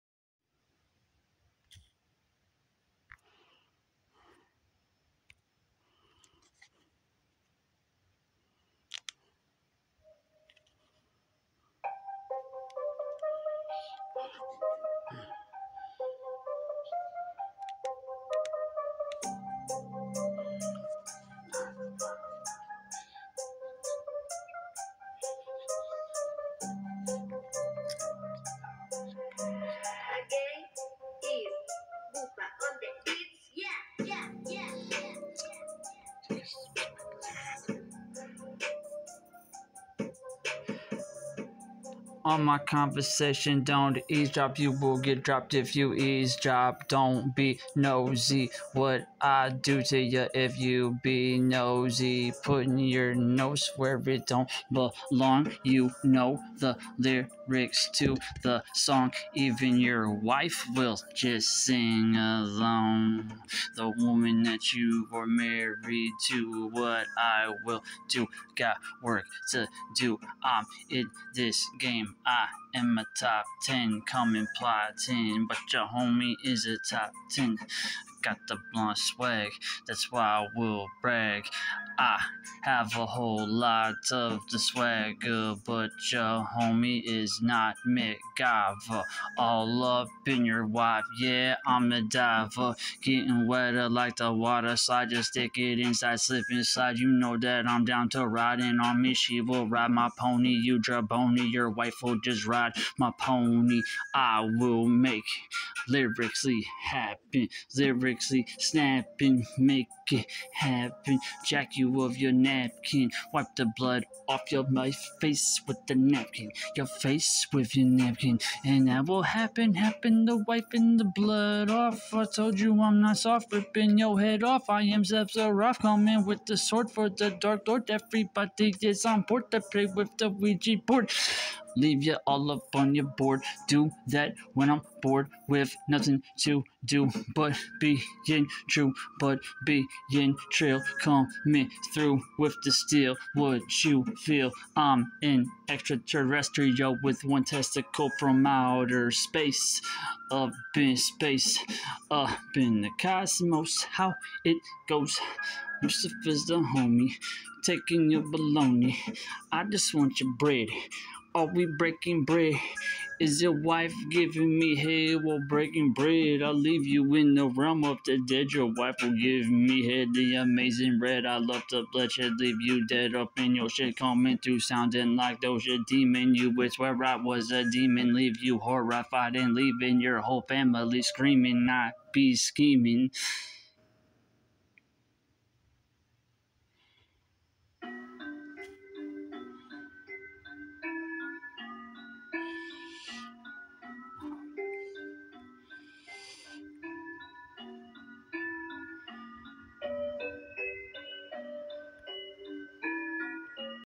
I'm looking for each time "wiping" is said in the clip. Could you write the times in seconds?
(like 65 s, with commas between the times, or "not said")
120 s.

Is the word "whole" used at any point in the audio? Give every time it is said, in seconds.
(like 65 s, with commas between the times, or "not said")
83 s, 180 s.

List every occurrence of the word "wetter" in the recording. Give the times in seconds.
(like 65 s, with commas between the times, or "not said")
93 s.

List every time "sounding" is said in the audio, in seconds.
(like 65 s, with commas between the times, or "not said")
174 s.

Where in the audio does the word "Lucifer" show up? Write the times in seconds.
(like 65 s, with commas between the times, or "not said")
155 s.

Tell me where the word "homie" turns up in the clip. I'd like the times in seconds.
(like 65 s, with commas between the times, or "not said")
75 s, 86 s, 156 s.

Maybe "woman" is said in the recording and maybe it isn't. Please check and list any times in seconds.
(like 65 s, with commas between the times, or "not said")
63 s.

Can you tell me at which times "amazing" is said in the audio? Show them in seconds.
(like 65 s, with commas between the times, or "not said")
170 s.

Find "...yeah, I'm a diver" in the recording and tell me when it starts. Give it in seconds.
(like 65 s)
91 s.